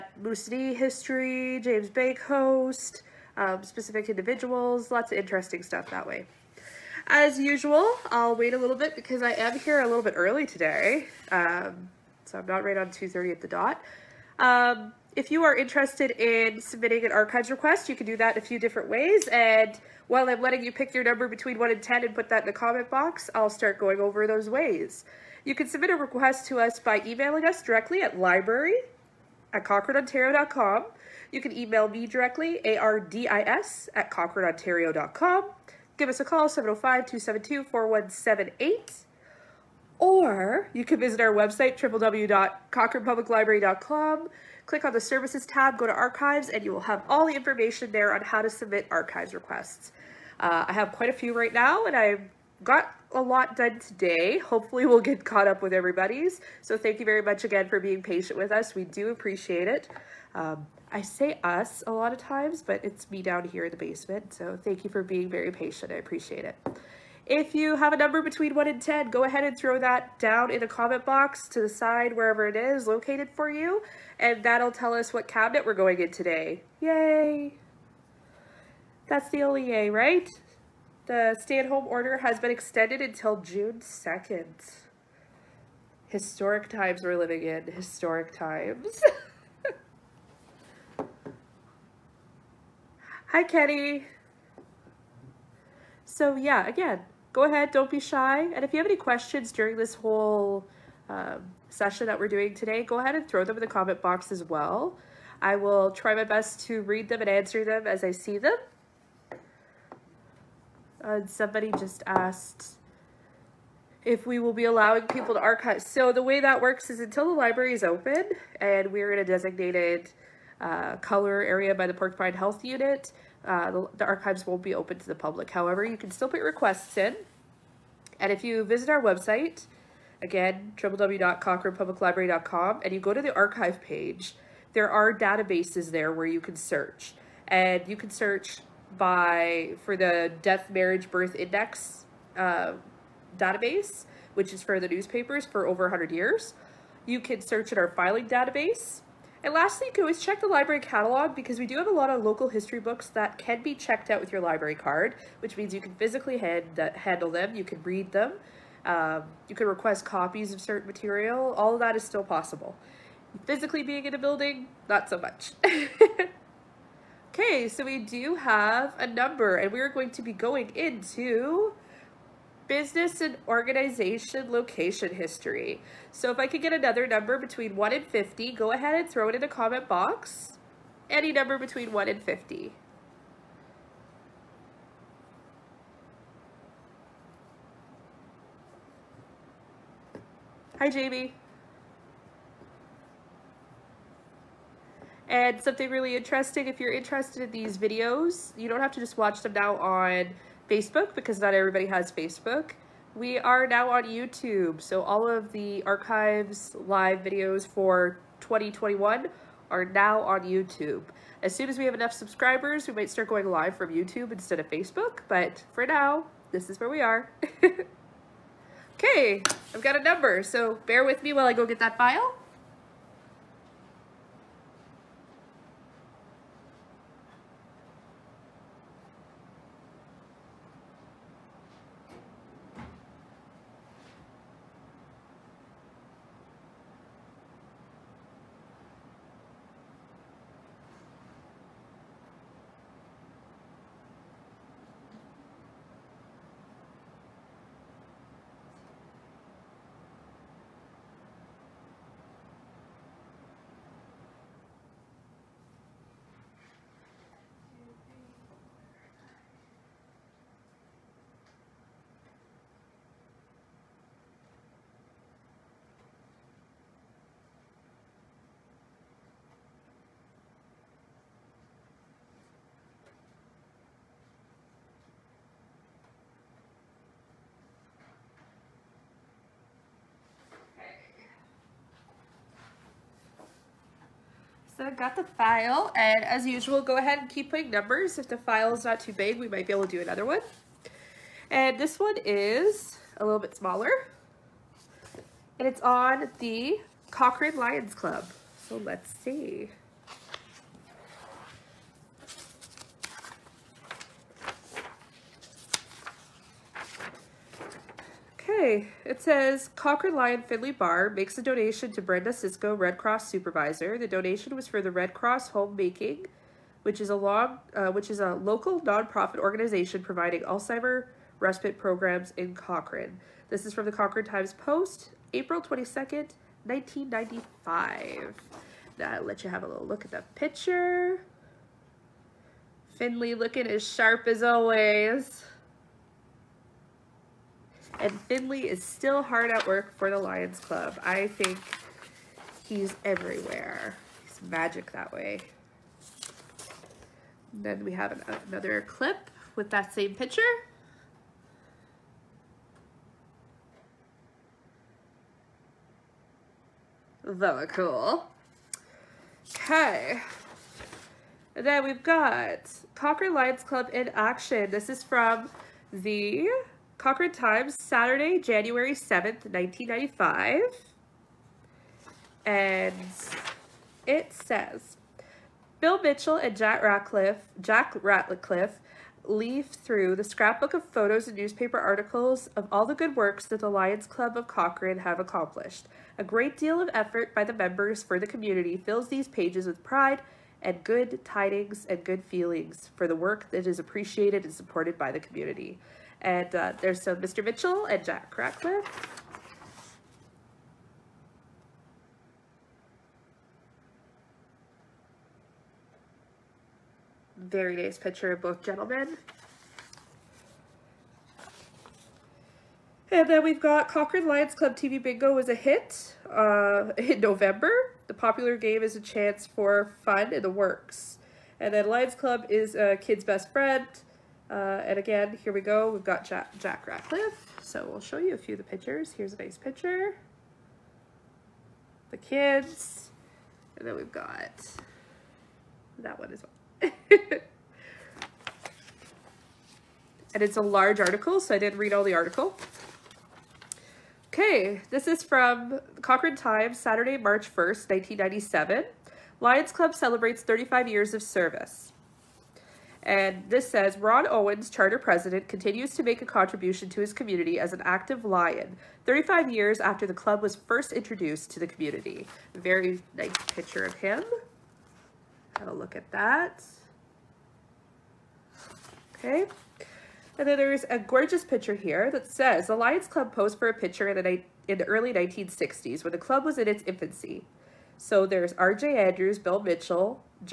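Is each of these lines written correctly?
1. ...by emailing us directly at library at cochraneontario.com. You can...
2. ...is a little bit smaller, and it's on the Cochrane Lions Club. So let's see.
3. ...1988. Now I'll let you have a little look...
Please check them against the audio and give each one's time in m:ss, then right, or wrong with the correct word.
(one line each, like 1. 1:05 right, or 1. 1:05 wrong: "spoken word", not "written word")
1. 0:26 right
2. 4:52 right
3. 5:26 wrong: "1995", not "1988".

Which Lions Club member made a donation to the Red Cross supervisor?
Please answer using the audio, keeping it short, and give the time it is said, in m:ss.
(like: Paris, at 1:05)
Finley Barr, at 5:10.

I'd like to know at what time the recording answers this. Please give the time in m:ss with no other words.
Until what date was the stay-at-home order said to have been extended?
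1:23.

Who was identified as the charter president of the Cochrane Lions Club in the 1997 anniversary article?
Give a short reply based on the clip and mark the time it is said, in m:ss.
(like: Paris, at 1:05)
Ron Owens, at 7:33.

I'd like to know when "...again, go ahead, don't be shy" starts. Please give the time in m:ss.
1:36.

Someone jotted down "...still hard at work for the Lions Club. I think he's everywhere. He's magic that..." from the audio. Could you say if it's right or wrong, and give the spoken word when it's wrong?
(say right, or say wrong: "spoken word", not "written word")
right.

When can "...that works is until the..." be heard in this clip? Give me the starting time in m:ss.
1:56.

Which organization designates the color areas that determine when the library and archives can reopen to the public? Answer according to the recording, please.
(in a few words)
Porcupine Health Unit.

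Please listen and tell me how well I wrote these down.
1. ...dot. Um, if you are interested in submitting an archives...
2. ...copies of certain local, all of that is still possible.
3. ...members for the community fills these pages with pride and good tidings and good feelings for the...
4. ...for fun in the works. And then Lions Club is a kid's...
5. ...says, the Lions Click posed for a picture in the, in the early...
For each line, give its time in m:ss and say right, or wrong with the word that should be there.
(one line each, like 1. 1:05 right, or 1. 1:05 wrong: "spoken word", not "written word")
1. 0:13 right
2. 2:40 wrong: "material", not "local"
3. 6:27 right
4. 6:59 right
5. 7:52 wrong: "Club", not "Click".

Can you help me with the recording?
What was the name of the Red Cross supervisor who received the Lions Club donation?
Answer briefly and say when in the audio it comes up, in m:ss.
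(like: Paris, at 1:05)
Brenda Cisco, at 5:12.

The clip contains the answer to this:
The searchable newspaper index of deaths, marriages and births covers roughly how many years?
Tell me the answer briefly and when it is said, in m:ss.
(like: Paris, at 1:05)
over 100 years, at 2:25.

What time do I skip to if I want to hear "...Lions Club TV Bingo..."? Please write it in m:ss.
6:54.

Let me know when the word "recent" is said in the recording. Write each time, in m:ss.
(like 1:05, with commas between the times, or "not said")
not said.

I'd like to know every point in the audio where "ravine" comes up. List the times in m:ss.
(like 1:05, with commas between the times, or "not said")
not said.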